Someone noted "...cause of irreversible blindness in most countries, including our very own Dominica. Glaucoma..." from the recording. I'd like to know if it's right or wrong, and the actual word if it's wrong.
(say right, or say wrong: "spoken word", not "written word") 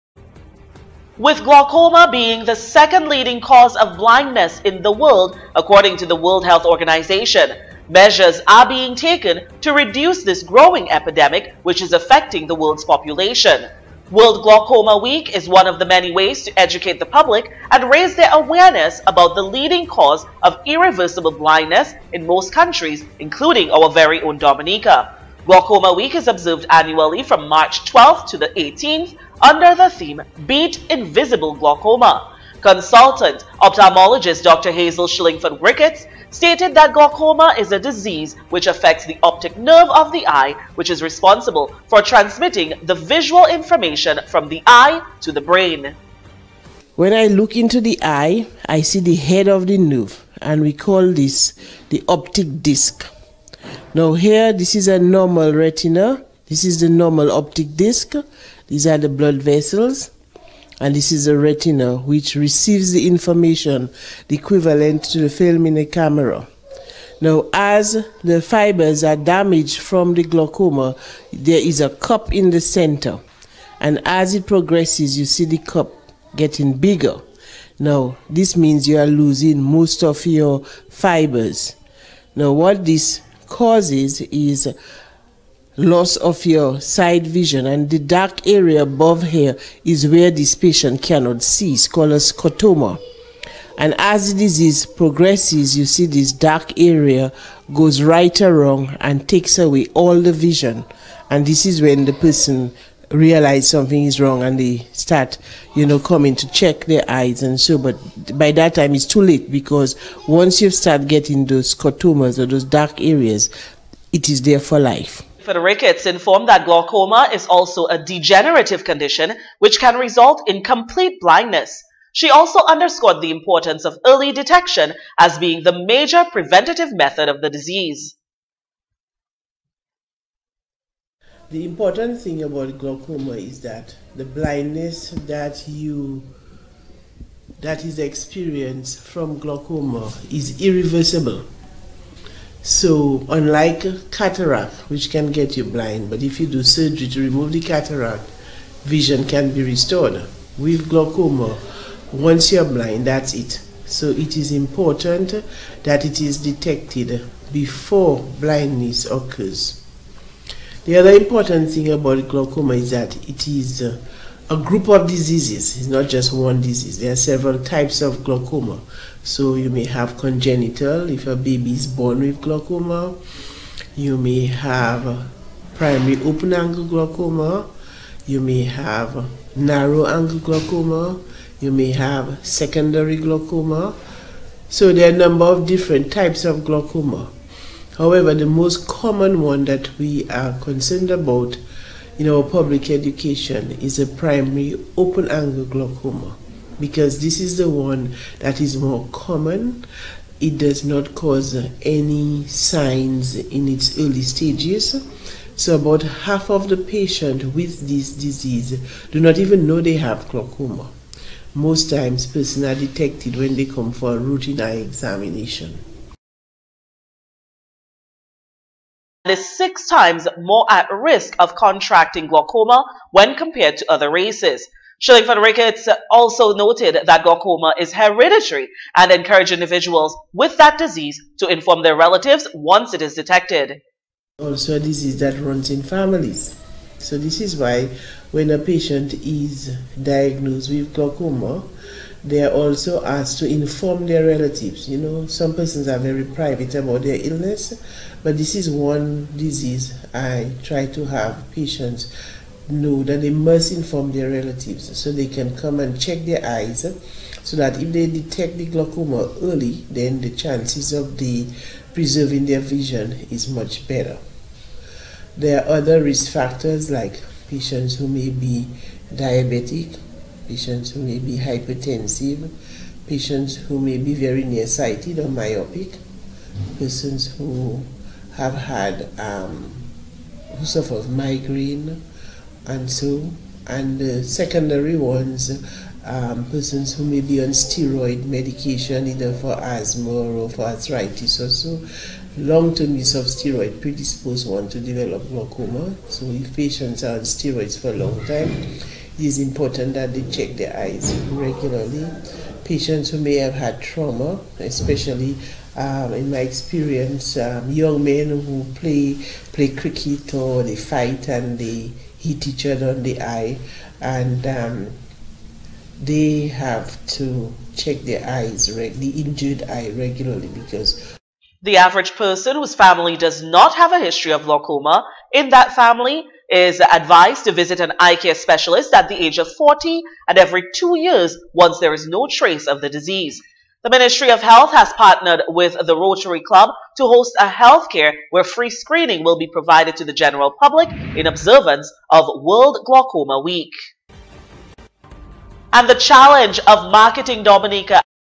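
right.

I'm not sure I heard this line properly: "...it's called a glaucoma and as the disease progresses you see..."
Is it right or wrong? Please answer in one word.
wrong.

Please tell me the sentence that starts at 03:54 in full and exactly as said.
Also, a disease that runs in families.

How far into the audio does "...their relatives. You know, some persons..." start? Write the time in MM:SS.
04:04.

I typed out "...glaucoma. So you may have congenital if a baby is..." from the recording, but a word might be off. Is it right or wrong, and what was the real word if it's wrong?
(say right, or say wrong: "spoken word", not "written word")
right.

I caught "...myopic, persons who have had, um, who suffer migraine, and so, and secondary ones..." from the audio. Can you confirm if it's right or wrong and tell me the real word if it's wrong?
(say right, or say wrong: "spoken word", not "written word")
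right.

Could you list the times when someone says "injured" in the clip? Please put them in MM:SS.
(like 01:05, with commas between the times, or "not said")
05:19.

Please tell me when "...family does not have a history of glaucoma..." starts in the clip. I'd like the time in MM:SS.
05:22.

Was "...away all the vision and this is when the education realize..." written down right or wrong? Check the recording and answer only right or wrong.
wrong.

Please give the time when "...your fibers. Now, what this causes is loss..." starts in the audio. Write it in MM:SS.
01:20.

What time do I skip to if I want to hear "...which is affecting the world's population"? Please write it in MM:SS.
00:11.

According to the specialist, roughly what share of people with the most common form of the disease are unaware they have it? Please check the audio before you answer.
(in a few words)
half.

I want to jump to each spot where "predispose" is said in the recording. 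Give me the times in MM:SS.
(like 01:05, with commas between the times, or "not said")
04:53.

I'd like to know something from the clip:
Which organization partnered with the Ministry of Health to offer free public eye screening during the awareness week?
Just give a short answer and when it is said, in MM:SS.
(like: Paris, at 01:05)
Rotary Club, at 05:35.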